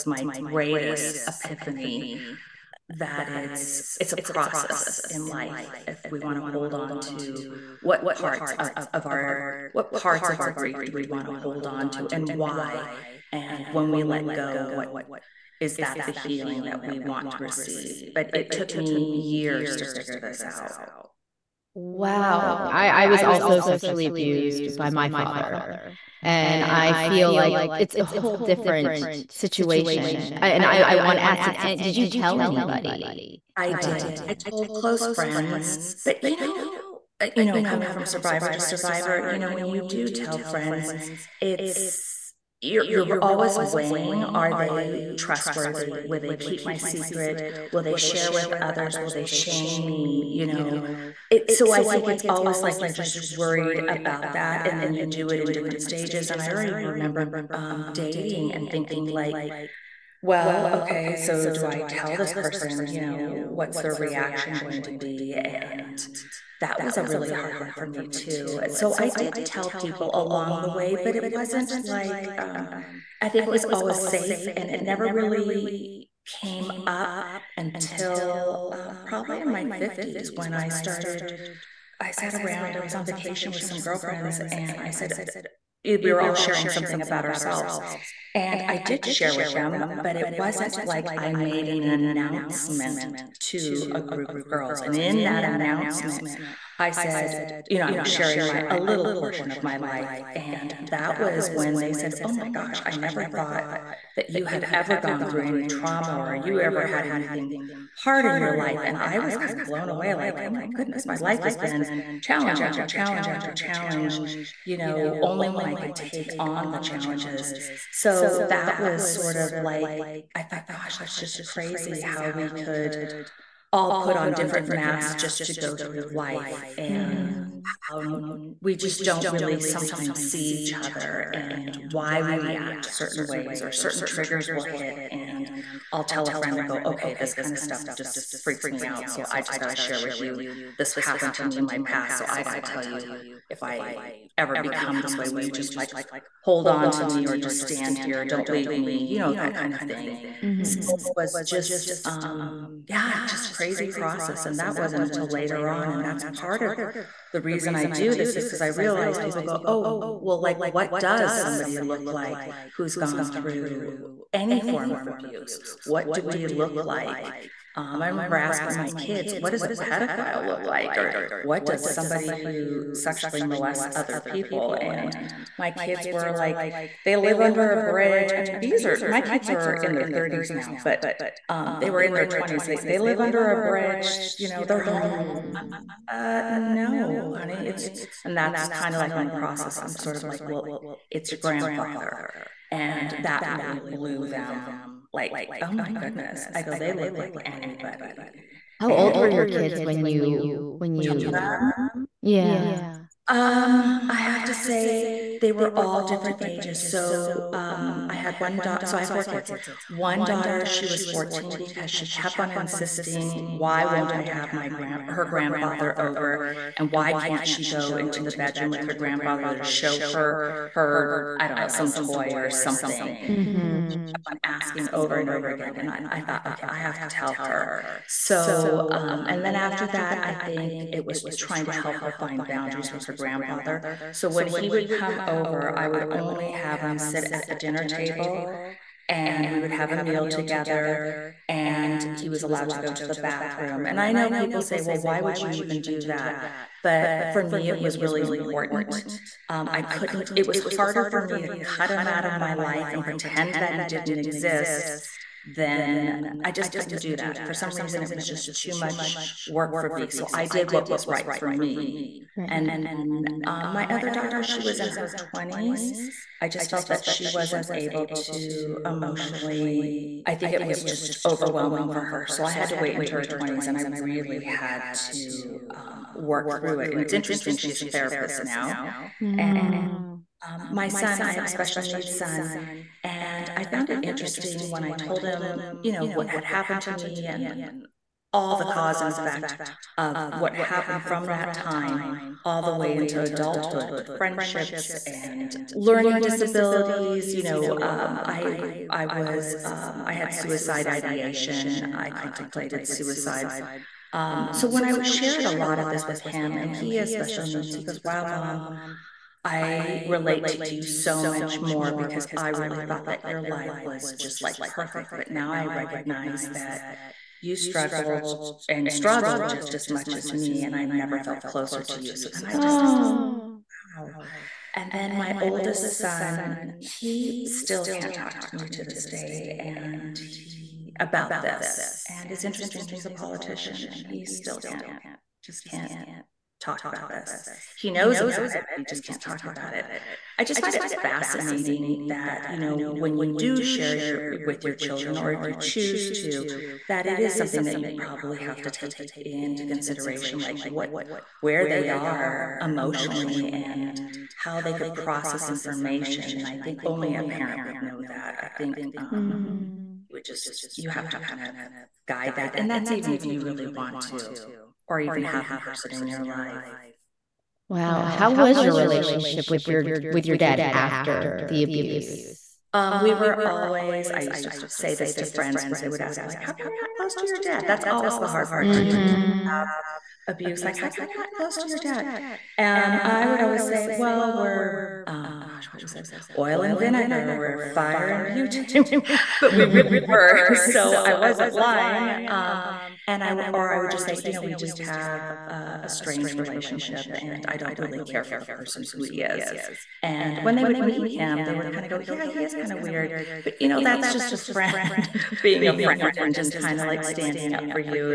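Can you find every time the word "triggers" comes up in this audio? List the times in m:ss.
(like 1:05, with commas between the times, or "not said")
2:14.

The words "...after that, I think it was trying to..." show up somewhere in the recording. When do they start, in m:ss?
3:49.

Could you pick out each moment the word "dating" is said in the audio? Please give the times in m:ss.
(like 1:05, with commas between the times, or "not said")
0:57.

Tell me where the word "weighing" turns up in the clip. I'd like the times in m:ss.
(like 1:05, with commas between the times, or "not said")
0:43.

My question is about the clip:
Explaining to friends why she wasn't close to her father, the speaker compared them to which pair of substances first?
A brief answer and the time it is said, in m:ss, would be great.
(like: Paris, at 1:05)
oil and vinegar, at 6:26.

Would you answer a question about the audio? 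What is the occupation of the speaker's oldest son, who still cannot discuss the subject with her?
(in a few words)
politician.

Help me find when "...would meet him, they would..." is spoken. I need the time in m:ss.
6:40.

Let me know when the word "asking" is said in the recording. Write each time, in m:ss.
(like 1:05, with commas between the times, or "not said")
2:48, 3:44.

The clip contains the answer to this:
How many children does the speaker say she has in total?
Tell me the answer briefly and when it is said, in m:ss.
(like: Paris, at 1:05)
4, at 3:29.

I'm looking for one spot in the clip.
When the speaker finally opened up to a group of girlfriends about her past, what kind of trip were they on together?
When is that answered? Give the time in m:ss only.
1:23.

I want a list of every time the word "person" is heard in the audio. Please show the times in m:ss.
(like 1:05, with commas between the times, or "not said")
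1:02, 6:05, 6:38.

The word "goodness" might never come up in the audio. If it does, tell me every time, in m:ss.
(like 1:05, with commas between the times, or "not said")
1:50, 3:15.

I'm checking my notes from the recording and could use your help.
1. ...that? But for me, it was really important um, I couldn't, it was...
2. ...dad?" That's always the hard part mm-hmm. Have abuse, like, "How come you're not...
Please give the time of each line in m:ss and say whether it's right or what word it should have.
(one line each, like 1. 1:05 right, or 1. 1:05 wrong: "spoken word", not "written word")
1. 4:06 right
2. 6:17 right.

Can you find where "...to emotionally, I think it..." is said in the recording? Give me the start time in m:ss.
4:28.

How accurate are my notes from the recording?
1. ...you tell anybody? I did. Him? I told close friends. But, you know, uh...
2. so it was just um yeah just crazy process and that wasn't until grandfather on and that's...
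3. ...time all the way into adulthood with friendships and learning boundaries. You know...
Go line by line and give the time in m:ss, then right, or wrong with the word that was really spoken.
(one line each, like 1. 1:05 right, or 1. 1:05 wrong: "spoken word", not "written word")
1. 0:31 right
2. 2:30 wrong: "later", not "grandfather"
3. 4:51 wrong: "disabilities", not "boundaries".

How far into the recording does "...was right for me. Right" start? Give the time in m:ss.
4:20.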